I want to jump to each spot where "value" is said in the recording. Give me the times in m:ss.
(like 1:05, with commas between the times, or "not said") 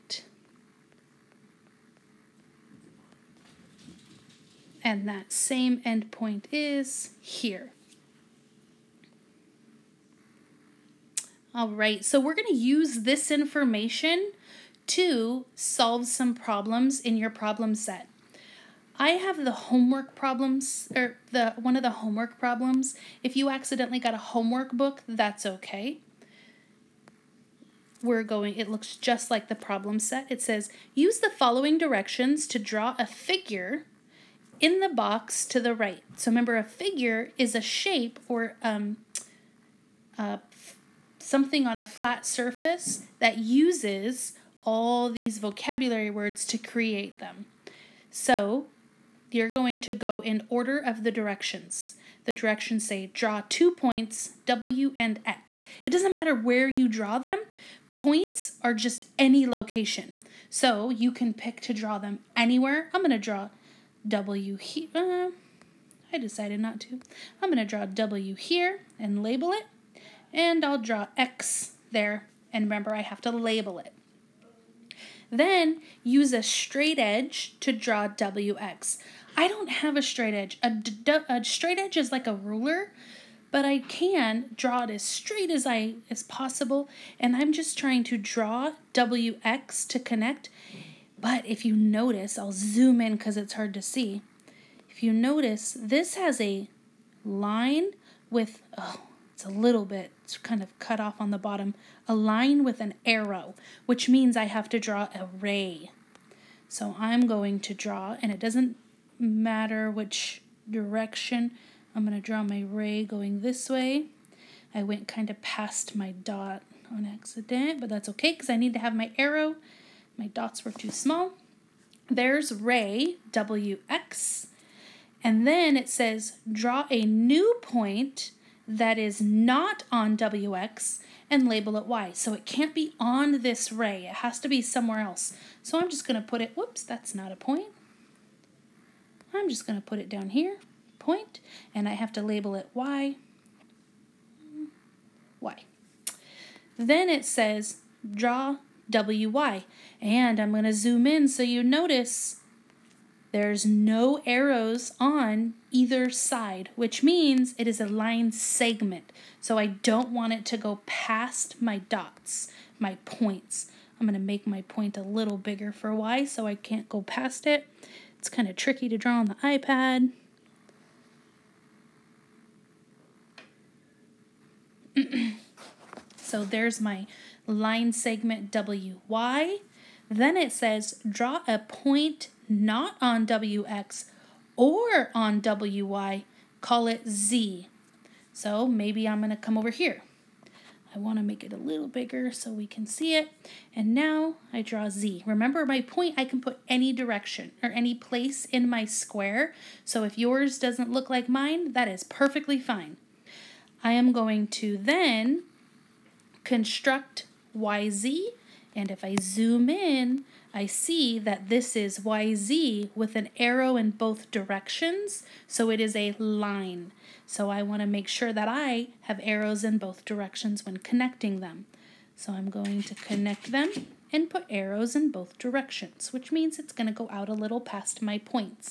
not said.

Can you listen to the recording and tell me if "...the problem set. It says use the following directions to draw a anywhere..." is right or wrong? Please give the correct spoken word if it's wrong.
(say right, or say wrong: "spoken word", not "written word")
wrong: "figure", not "anywhere".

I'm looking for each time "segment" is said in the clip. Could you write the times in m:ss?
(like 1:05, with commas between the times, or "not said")
2:38, 2:57.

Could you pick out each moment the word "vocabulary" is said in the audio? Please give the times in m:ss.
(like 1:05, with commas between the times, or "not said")
0:45.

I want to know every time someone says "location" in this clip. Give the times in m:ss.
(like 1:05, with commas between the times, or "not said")
0:59.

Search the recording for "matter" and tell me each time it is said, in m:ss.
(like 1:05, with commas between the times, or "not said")
0:56, 1:49.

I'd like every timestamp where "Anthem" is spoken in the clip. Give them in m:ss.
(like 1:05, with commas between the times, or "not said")
not said.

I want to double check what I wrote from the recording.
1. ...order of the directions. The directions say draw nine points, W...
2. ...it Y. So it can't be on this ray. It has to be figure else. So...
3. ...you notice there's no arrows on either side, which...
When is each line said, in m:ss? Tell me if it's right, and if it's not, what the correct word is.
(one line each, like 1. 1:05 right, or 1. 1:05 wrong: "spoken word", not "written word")
1. 0:50 wrong: "two", not "nine"
2. 2:11 wrong: "somewhere", not "figure"
3. 2:31 right.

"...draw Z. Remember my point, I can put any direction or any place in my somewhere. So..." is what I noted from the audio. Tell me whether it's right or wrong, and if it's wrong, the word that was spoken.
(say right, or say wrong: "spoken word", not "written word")
wrong: "square", not "somewhere".